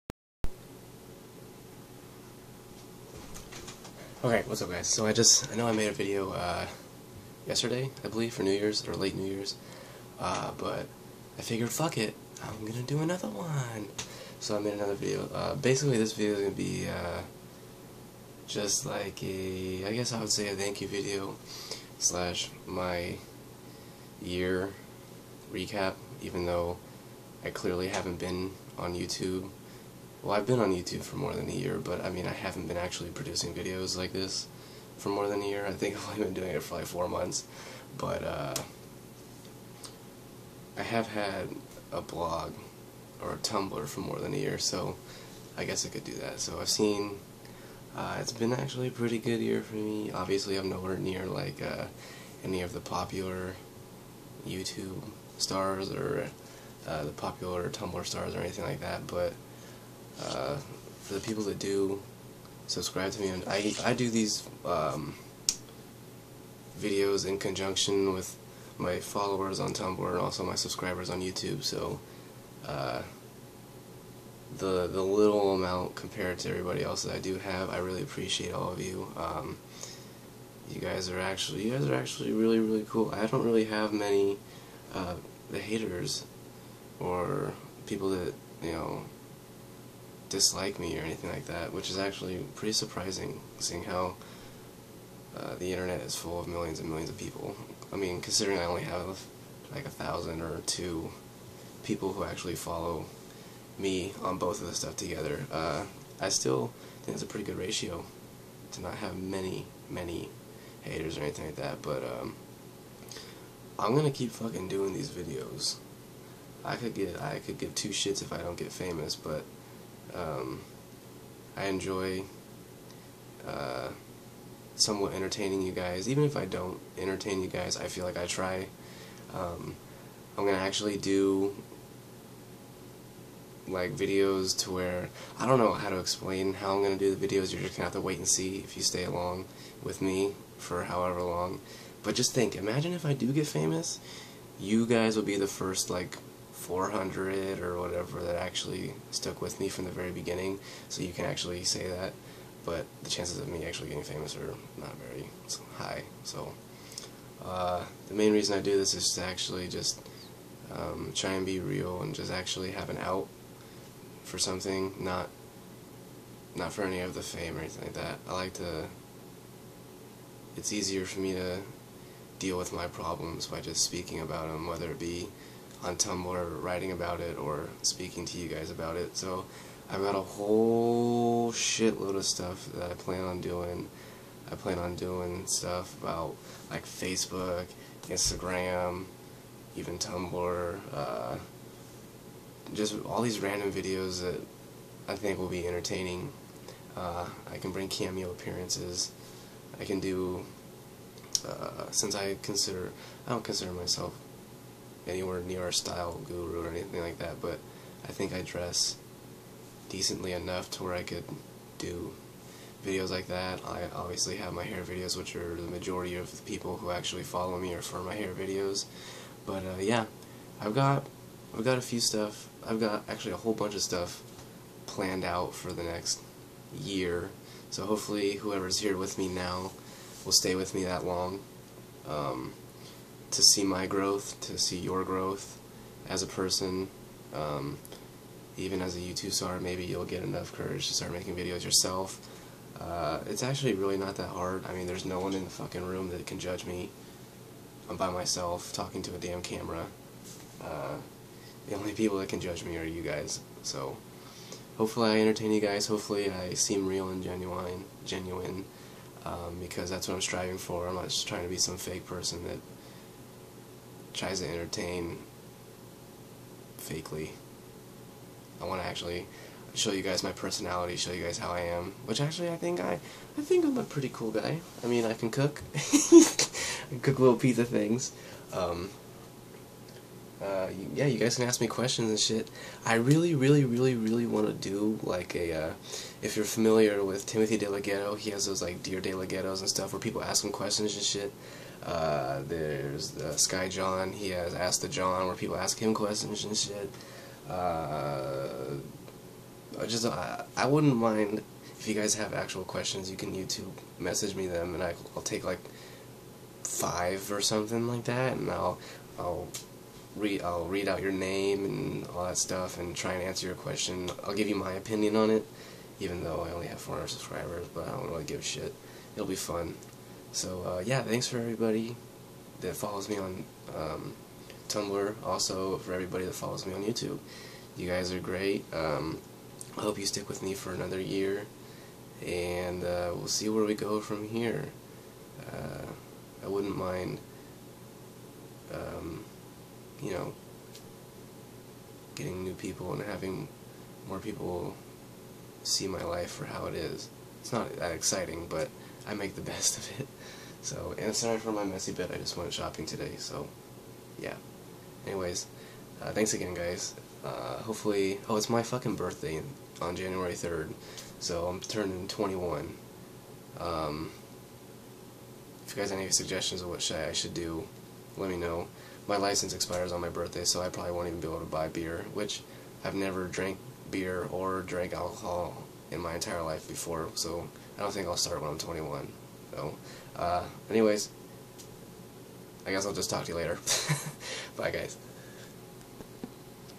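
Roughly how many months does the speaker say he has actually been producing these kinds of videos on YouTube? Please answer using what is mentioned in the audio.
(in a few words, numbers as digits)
4 months.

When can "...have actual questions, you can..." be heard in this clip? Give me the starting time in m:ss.
5:02.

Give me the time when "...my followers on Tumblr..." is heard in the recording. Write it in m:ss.
1:08.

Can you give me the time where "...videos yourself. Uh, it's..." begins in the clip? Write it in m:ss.
4:01.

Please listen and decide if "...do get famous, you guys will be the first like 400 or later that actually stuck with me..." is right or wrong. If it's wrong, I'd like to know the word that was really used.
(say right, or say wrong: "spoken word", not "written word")
wrong: "whatever", not "later".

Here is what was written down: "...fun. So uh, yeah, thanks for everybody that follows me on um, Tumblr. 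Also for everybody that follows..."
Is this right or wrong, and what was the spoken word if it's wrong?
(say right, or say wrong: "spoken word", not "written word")
right.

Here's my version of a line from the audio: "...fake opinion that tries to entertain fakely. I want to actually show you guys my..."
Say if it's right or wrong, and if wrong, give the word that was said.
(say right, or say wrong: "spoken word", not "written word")
wrong: "person", not "opinion".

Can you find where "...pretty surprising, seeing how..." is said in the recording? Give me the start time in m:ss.
1:32.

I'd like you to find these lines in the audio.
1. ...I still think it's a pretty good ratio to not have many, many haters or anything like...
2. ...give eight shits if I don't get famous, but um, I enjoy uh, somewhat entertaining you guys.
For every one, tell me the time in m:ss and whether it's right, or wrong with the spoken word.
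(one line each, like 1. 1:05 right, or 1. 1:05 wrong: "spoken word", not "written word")
1. 1:46 right
2. 1:57 wrong: "two", not "eight".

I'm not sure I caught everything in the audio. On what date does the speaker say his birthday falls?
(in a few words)
January 3rd.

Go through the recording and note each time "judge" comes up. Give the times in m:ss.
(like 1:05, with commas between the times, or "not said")
4:06, 4:12.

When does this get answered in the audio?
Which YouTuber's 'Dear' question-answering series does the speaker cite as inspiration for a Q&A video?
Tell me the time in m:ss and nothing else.
4:47.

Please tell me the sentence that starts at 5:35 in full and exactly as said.
Uh, I wouldn't mind you know, getting new people and having more people see my life for how it is.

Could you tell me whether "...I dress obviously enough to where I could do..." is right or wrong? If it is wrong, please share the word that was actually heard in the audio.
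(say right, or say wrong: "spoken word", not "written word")
wrong: "decently", not "obviously".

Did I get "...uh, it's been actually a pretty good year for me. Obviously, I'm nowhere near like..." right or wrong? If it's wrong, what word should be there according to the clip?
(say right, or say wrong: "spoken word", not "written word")
right.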